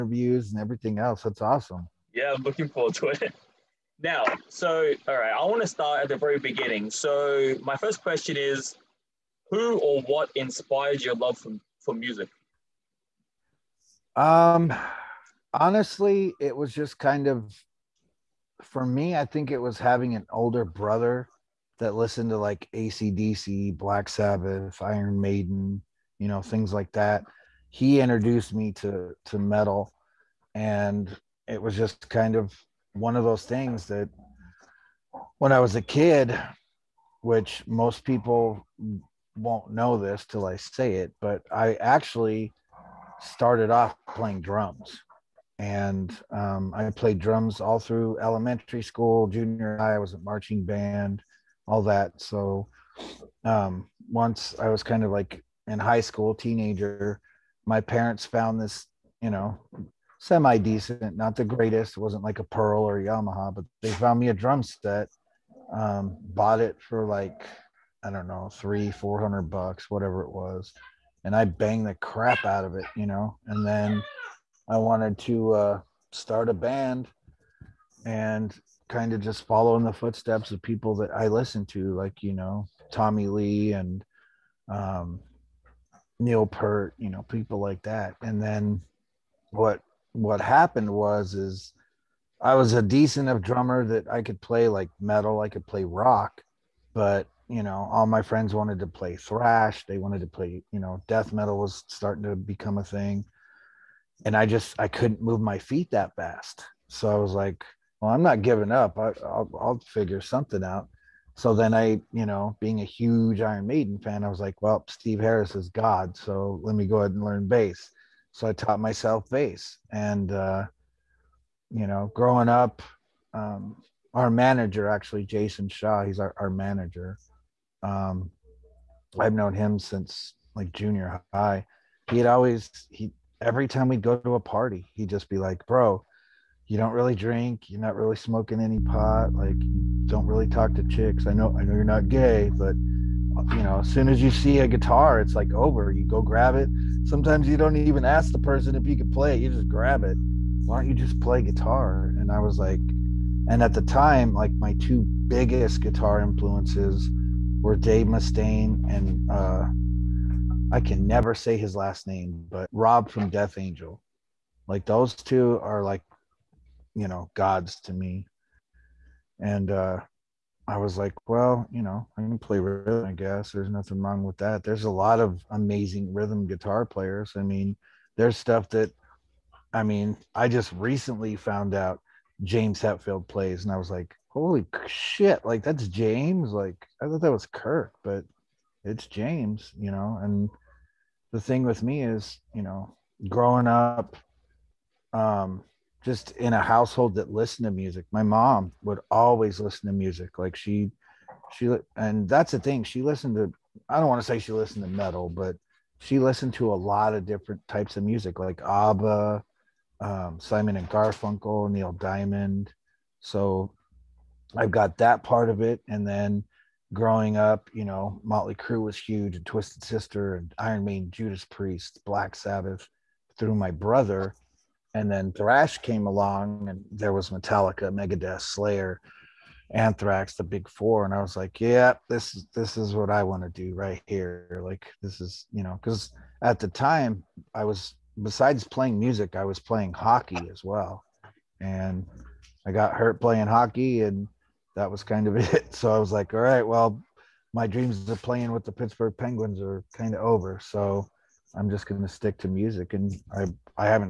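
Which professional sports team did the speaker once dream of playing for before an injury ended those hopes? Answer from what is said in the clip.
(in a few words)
Pittsburgh Penguins.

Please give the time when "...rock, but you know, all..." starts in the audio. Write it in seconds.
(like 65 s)
95 s.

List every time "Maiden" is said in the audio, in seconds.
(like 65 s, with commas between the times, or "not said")
25 s, 113 s, 220 s.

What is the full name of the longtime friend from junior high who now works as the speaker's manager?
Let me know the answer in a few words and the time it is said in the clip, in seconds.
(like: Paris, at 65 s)
Jason Shaw, at 125 s.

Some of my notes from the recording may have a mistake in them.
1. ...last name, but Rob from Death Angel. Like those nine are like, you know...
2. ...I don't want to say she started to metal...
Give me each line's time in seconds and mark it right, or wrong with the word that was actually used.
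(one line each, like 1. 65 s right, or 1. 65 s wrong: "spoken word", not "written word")
1. 161 s wrong: "two", not "nine"
2. 203 s wrong: "listened", not "started".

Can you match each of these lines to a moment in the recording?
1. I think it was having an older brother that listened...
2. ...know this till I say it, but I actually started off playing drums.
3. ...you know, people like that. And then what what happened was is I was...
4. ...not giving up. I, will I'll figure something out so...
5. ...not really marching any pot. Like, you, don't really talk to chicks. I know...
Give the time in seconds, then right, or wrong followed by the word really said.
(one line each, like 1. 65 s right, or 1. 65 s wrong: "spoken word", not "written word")
1. 19 s right
2. 39 s right
3. 86 s right
4. 108 s right
5. 137 s wrong: "smoking", not "marching".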